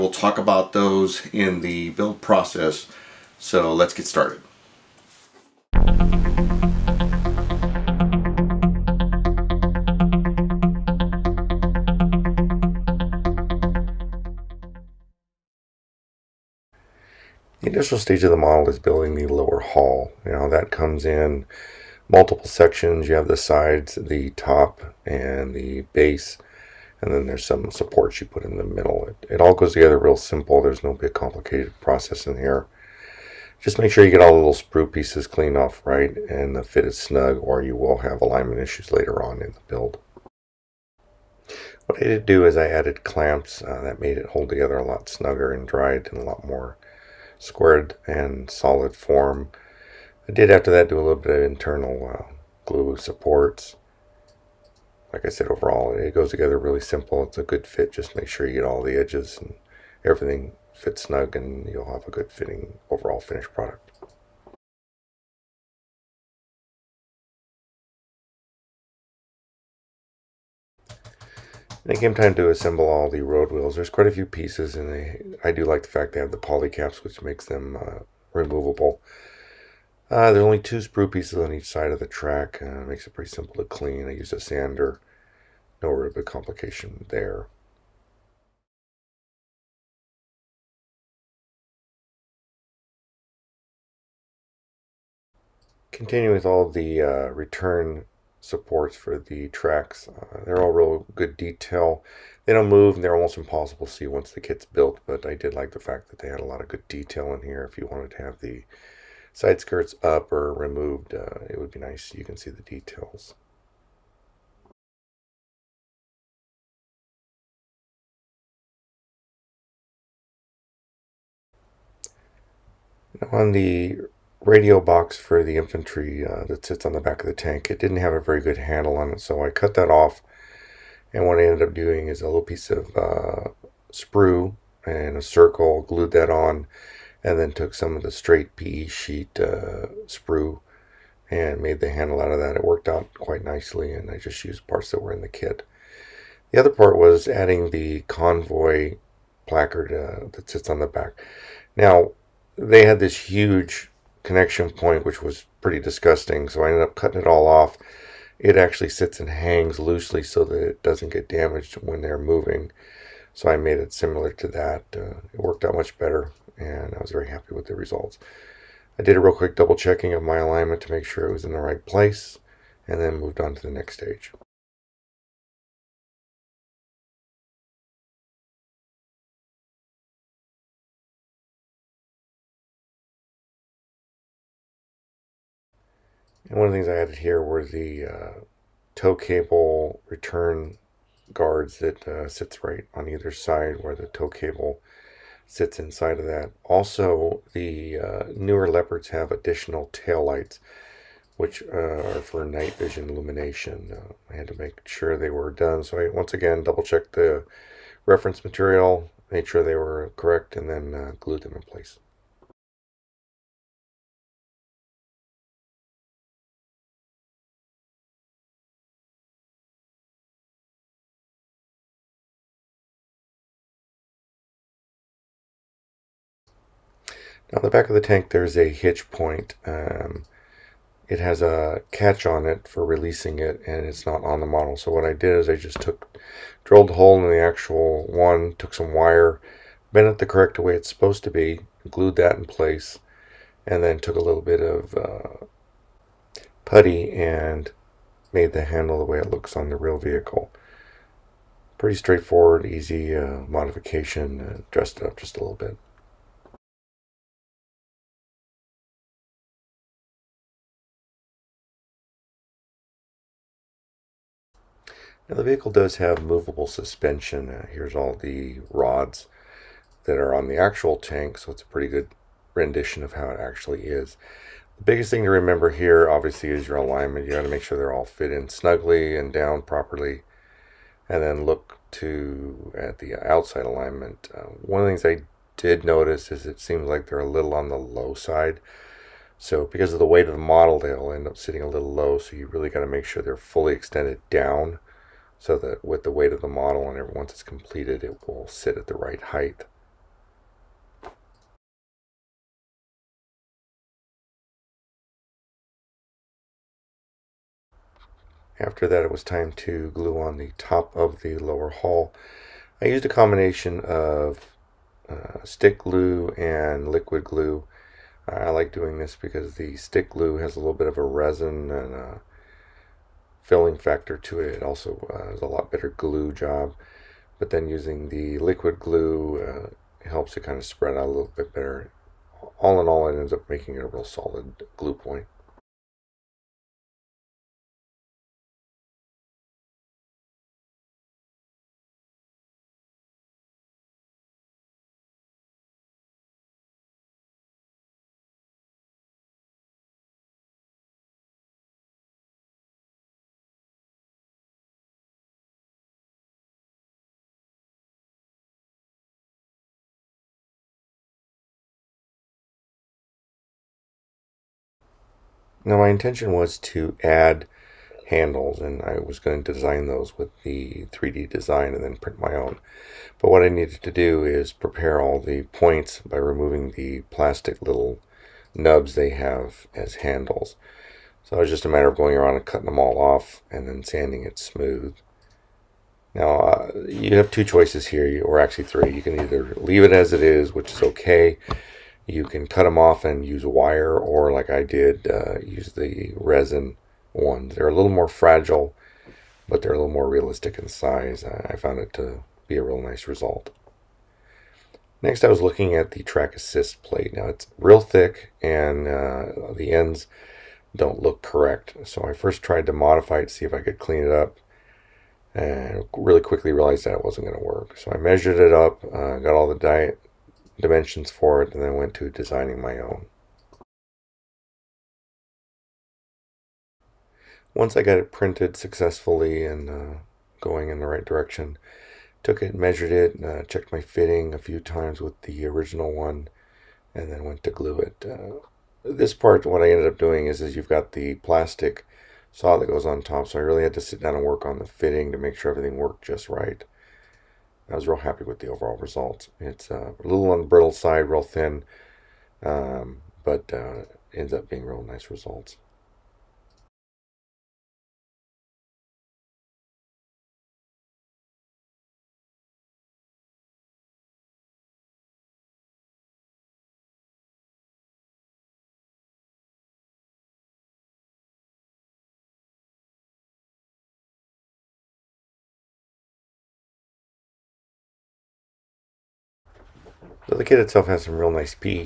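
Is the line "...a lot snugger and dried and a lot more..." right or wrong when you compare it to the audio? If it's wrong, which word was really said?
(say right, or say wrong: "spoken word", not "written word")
right.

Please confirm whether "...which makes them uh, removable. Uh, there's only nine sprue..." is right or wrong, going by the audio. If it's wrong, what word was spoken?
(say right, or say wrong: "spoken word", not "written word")
wrong: "two", not "nine".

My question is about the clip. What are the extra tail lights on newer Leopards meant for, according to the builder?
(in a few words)
Night vision illumination.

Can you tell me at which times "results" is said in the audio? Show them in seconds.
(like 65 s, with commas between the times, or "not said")
167 s, 403 s, 448 s, 455 s.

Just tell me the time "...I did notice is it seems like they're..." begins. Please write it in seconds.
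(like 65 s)
285 s.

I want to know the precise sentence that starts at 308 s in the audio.
After that it was time to glue on the top of the lower hull.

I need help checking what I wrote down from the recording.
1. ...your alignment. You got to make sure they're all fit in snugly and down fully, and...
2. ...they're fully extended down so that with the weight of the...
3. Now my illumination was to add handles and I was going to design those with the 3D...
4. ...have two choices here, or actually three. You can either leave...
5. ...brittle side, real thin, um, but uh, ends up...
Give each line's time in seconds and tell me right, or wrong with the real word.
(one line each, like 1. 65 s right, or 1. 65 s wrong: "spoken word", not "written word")
1. 276 s wrong: "properly", not "fully"
2. 293 s right
3. 365 s wrong: "intention", not "illumination"
4. 387 s right
5. 450 s right.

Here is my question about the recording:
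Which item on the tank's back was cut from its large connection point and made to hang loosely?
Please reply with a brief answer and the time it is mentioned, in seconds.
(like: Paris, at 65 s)
Convoy placard, at 148 s.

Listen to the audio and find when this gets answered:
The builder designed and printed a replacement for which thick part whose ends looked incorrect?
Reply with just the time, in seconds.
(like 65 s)
406 s.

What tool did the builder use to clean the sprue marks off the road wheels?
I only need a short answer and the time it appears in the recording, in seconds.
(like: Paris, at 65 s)
A sander, at 84 s.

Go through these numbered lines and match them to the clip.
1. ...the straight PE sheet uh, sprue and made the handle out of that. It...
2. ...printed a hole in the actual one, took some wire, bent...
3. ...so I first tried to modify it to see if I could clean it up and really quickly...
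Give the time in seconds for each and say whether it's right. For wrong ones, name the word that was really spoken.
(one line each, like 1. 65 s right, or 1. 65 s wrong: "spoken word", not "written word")
1. 138 s right
2. 236 s wrong: "drilled", not "printed"
3. 411 s right.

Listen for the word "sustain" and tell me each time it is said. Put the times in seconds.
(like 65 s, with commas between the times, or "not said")
not said.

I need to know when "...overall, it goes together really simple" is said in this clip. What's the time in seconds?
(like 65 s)
55 s.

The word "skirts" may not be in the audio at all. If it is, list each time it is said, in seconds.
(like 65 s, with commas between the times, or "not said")
109 s.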